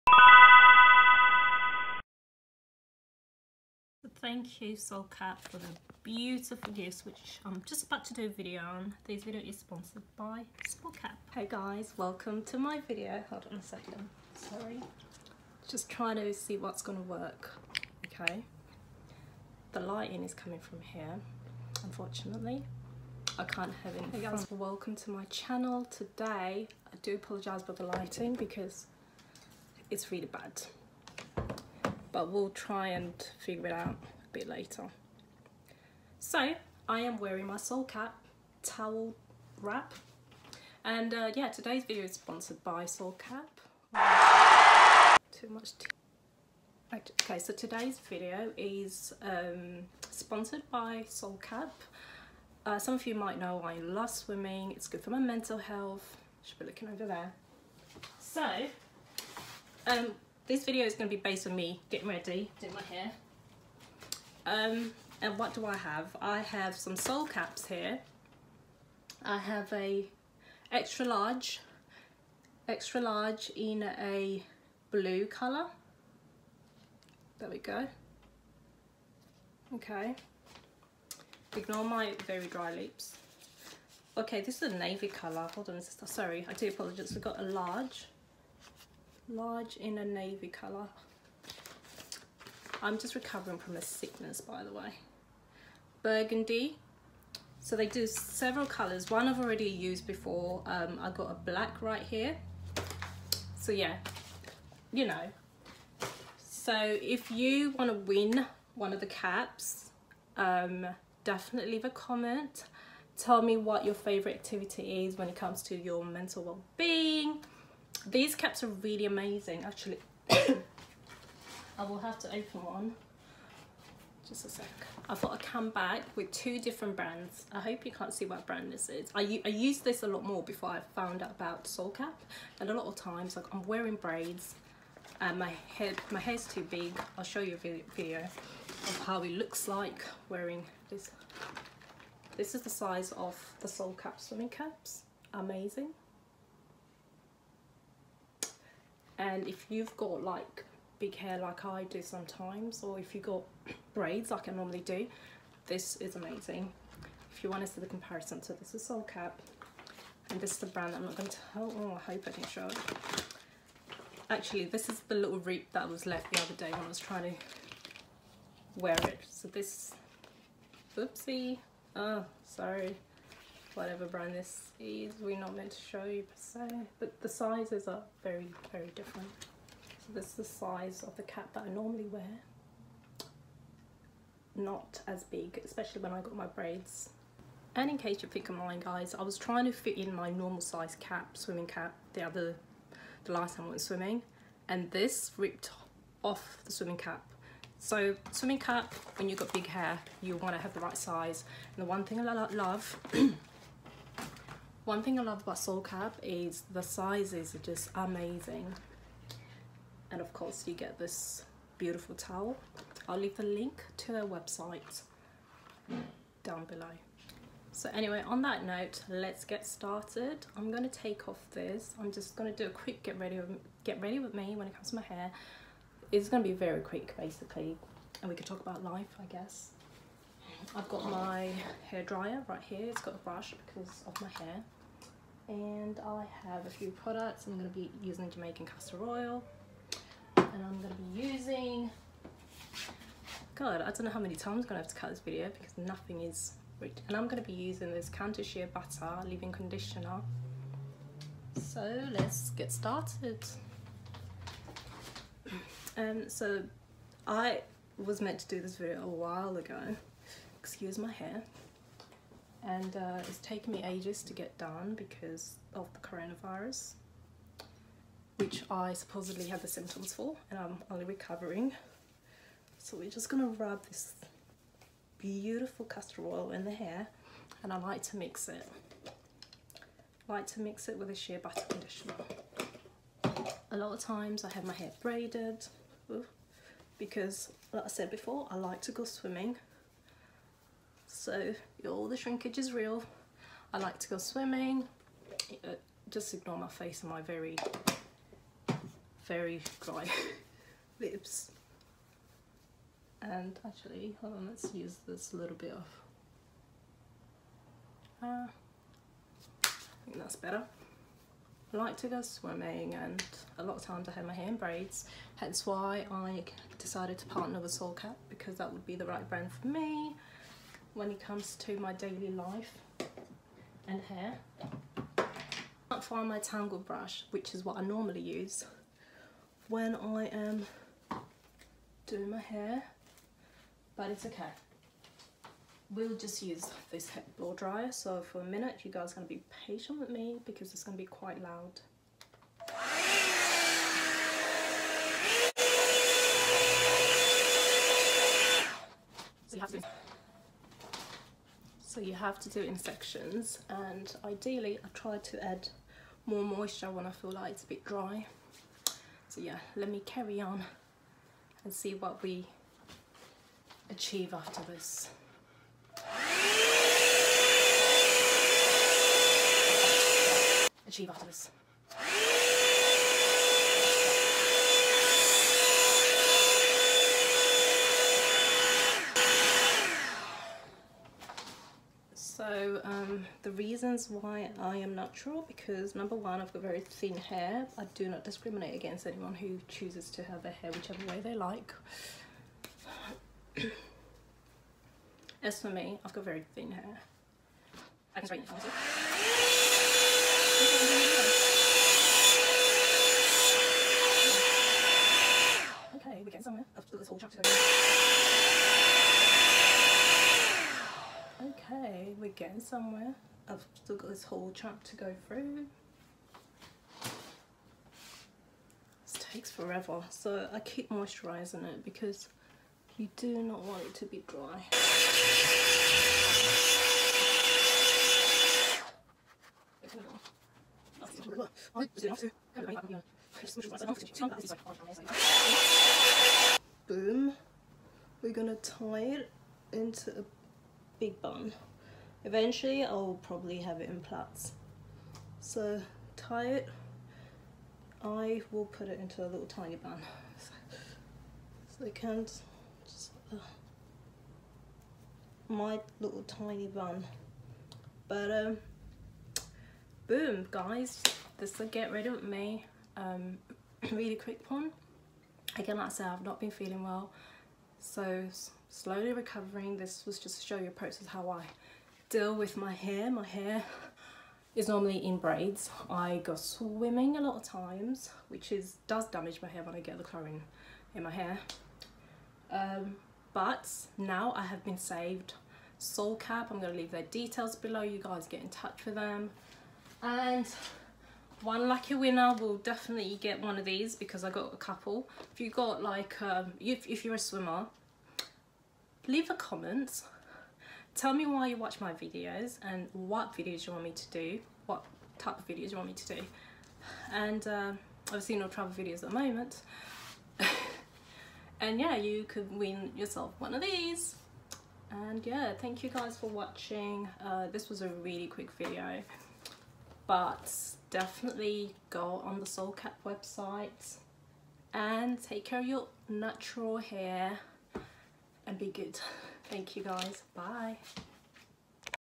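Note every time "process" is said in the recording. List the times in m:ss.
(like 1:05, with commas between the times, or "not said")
7:50.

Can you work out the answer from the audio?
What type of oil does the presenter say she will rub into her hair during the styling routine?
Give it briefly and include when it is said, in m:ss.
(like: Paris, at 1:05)
Jamaican castor oil, at 3:58.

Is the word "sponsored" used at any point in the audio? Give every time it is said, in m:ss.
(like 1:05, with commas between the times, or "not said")
0:09, 0:42, 0:50.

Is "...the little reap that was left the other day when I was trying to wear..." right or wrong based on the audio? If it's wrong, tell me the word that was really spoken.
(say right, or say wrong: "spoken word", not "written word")
right.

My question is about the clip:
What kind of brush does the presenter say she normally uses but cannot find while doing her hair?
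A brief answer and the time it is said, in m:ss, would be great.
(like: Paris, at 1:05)
Tangle brush, at 5:26.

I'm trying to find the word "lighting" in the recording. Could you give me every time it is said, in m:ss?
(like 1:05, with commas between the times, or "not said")
0:19, 0:27.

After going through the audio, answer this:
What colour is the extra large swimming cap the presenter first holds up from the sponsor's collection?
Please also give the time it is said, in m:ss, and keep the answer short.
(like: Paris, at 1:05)
Blue, at 1:12.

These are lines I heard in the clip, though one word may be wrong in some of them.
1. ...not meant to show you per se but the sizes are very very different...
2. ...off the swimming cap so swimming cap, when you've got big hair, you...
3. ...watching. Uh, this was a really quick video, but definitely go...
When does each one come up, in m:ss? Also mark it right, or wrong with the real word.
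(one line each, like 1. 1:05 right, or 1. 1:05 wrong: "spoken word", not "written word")
1. 2:55 right
2. 3:16 right
3. 8:36 right.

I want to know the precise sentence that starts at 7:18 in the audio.
We're gonna tie it into a big bun.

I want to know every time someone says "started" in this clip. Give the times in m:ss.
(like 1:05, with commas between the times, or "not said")
3:39, 4:12.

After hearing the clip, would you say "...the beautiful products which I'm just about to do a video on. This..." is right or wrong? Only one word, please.
wrong.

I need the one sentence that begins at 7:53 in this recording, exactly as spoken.
My hair is normally in braids.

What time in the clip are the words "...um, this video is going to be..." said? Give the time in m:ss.
0:59.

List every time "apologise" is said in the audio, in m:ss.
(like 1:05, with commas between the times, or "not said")
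0:27, 1:26.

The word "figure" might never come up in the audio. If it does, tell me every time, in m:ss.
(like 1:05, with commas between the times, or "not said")
0:33.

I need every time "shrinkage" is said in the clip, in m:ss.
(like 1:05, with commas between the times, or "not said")
4:52.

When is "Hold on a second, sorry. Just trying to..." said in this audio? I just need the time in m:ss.
0:13.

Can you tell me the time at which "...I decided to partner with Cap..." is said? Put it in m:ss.
5:16.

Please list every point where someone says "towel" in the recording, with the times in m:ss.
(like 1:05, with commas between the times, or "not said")
0:38, 3:32.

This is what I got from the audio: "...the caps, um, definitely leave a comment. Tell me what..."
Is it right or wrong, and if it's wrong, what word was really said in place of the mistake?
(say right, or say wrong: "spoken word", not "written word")
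right.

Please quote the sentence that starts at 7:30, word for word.
So, so can just, uh, my little tiny bun.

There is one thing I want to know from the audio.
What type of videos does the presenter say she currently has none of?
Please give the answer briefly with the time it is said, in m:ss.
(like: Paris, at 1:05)
Travel videos, at 8:28.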